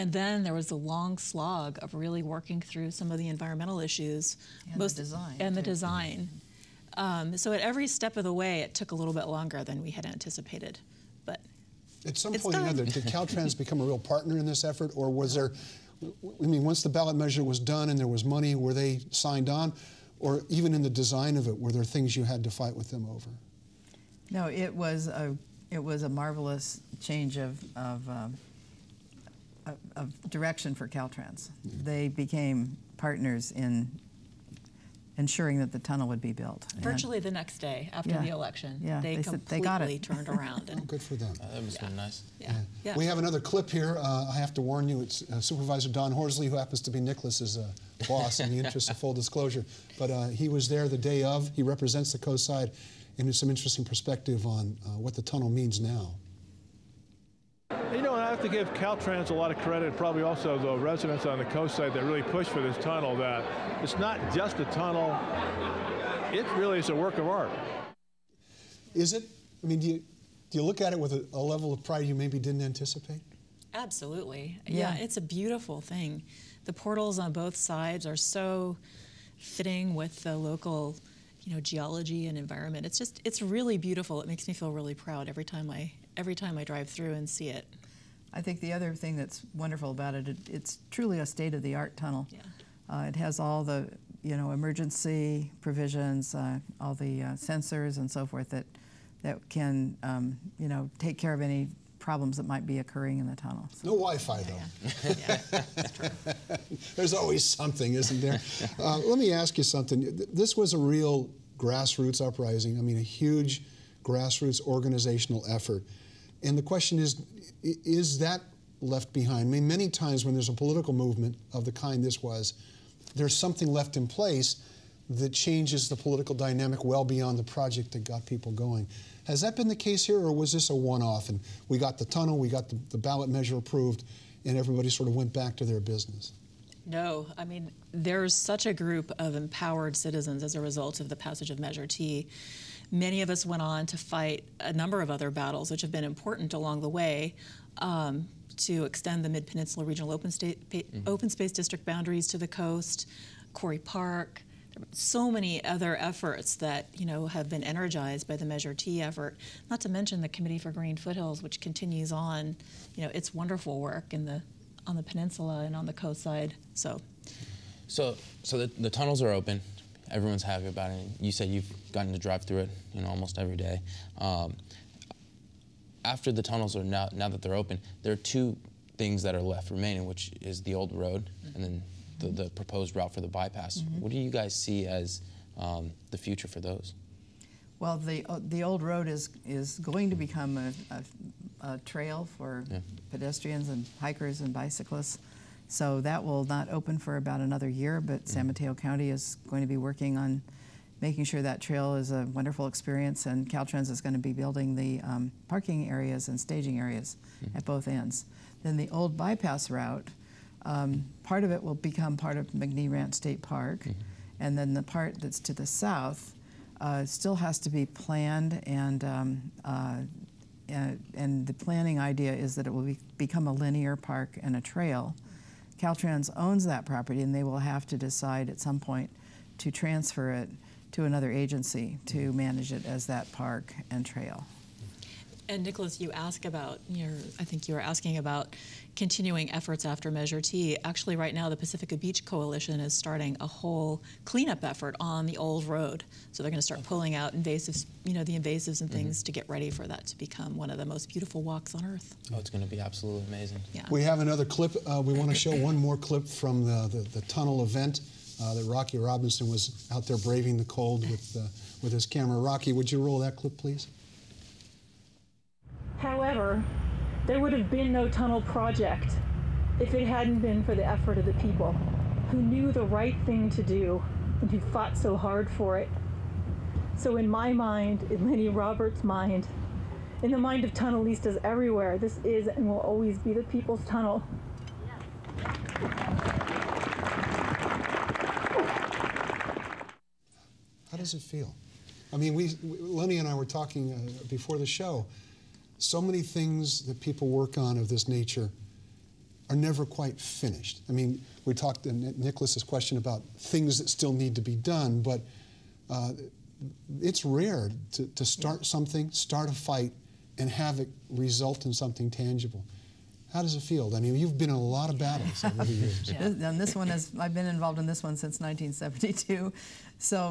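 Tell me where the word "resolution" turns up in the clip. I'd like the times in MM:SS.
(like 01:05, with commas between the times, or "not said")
not said.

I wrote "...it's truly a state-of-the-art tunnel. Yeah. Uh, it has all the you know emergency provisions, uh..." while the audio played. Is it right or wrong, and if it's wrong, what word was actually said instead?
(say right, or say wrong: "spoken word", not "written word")
right.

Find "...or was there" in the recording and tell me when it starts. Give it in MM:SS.
00:14.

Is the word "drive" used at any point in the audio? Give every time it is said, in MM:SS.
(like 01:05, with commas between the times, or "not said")
01:26, 02:52.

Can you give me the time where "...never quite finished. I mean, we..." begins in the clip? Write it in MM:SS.
04:59.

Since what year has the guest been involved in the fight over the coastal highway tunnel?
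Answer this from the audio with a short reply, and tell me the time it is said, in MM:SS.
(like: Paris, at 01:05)
1972, at 05:18.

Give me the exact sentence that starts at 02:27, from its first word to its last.
Um, to extend the Mid Peninsula Regional Open, State, mm -hmm.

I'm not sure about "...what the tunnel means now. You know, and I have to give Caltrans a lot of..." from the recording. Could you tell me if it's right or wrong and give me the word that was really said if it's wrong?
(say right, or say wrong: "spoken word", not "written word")
right.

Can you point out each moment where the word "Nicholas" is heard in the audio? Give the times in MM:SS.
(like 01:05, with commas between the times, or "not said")
00:46, 03:55, 05:02.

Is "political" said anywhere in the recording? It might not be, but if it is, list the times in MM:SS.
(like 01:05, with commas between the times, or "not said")
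02:00, 02:05.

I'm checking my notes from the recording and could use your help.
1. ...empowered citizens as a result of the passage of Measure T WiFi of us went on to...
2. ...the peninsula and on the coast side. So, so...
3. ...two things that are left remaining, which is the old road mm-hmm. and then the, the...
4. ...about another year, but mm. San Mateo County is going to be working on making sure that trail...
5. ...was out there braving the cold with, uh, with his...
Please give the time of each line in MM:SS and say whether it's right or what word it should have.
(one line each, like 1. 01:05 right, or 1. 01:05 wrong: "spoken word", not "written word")
1. 02:19 wrong: "Many", not "WiFi"
2. 02:44 right
3. 02:58 right
4. 03:17 right
5. 04:19 right.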